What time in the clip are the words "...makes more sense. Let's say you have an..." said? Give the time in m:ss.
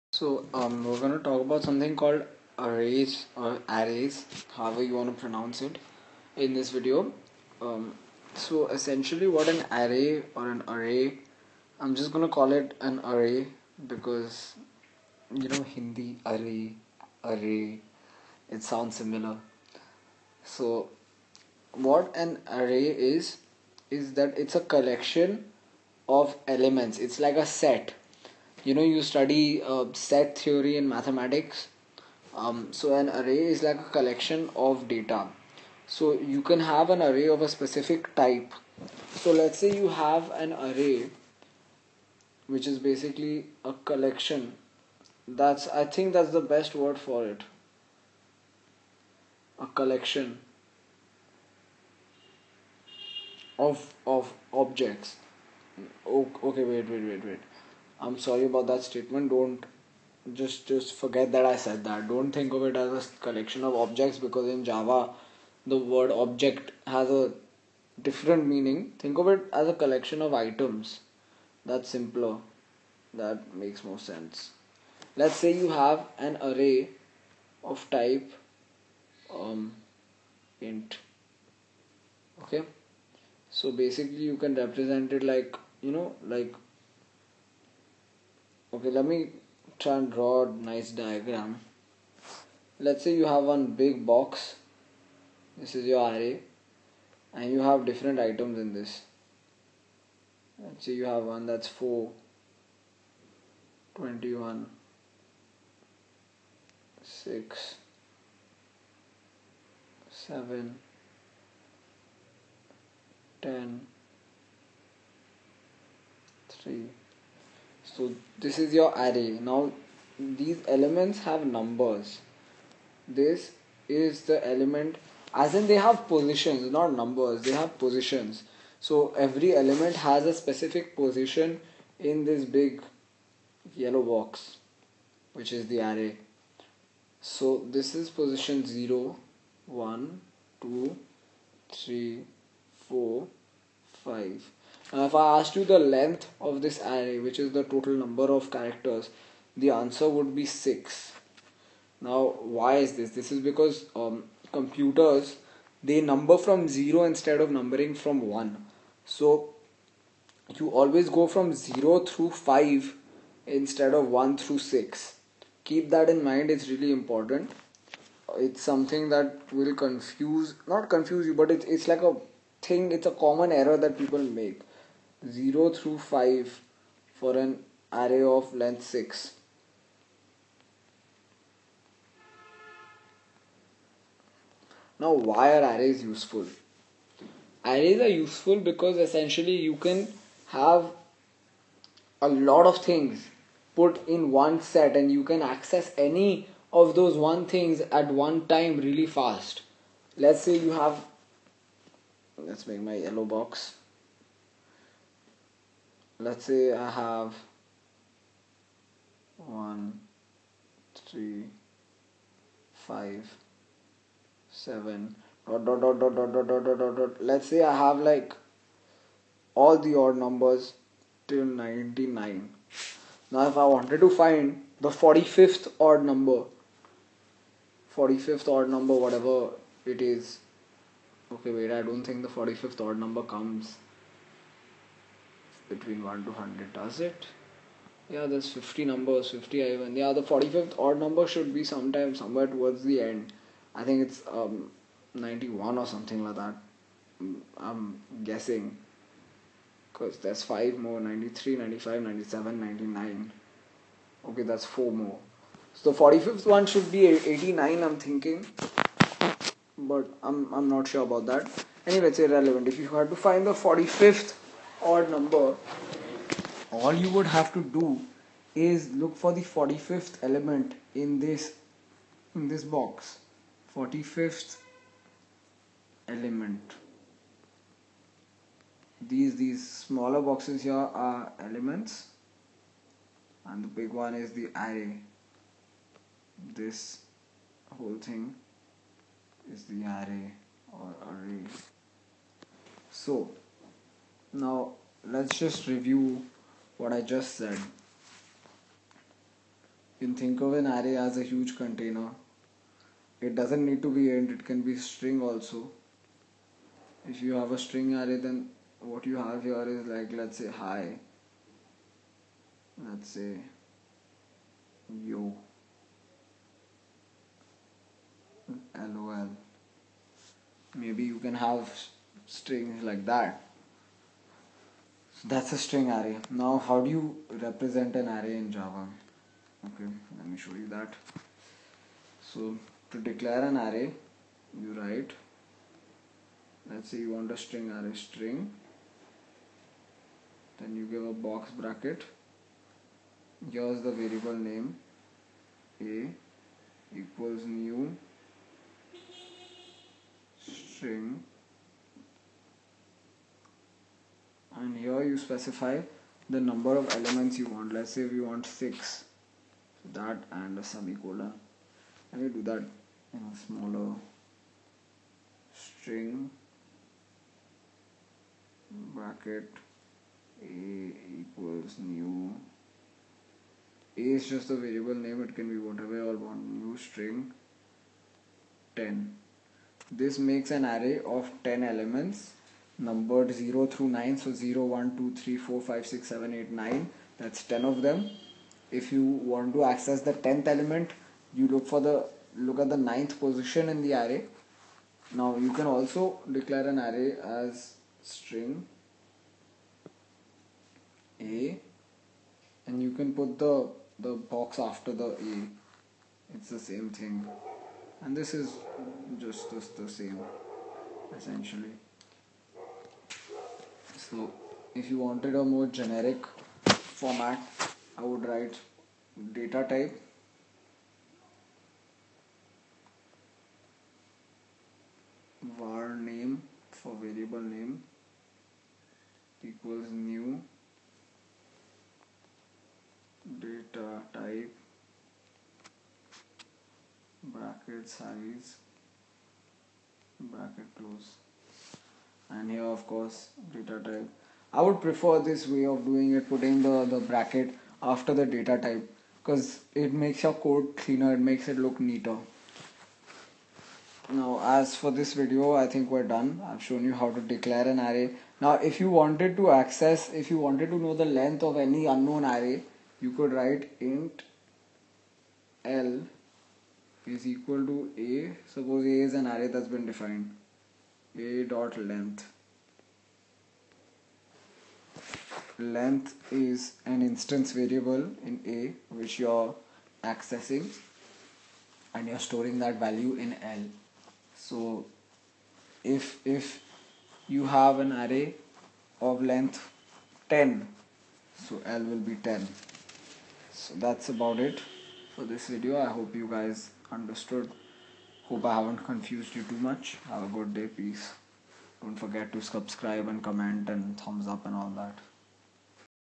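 1:13.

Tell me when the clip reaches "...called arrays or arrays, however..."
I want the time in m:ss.
0:01.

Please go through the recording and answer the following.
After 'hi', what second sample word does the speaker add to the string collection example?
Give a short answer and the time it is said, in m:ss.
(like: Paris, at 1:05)
yo, at 5:15.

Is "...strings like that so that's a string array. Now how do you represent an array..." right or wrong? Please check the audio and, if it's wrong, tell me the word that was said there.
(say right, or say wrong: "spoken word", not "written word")
right.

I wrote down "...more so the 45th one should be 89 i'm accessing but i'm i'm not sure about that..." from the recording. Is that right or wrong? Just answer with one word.
wrong.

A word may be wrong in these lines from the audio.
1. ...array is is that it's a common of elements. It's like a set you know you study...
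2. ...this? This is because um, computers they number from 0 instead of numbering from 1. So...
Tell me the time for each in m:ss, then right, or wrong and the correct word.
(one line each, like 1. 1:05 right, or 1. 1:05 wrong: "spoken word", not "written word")
1. 0:22 wrong: "collection", not "common"
2. 2:32 right.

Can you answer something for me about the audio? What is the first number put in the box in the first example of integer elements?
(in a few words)
4.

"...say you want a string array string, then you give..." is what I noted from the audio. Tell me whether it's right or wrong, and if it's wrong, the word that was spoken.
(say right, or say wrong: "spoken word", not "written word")
right.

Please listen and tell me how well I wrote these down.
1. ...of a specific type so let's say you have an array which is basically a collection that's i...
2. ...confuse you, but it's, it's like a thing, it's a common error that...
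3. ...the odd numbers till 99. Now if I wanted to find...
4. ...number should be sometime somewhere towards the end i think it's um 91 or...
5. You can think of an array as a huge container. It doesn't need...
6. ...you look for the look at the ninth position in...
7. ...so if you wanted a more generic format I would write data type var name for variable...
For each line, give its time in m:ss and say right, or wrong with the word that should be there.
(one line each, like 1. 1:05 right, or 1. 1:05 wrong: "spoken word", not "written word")
1. 0:37 right
2. 2:50 right
3. 3:39 right
4. 4:01 right
5. 4:59 right
6. 6:31 right
7. 6:54 right.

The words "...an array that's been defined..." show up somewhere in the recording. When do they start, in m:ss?
7:49.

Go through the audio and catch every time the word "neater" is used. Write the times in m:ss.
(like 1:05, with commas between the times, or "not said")
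7:31.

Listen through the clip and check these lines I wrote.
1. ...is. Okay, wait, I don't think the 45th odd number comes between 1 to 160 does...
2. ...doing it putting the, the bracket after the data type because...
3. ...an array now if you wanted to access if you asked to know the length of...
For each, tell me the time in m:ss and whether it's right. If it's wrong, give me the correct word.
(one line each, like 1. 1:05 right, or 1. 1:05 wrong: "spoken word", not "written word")
1. 3:50 wrong: "100", not "160"
2. 7:25 right
3. 7:37 wrong: "wanted", not "asked".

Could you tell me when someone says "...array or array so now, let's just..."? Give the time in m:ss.
4:49.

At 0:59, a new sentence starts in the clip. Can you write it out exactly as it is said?
Don't just just forget that I said that.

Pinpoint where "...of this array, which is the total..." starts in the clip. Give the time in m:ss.
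2:26.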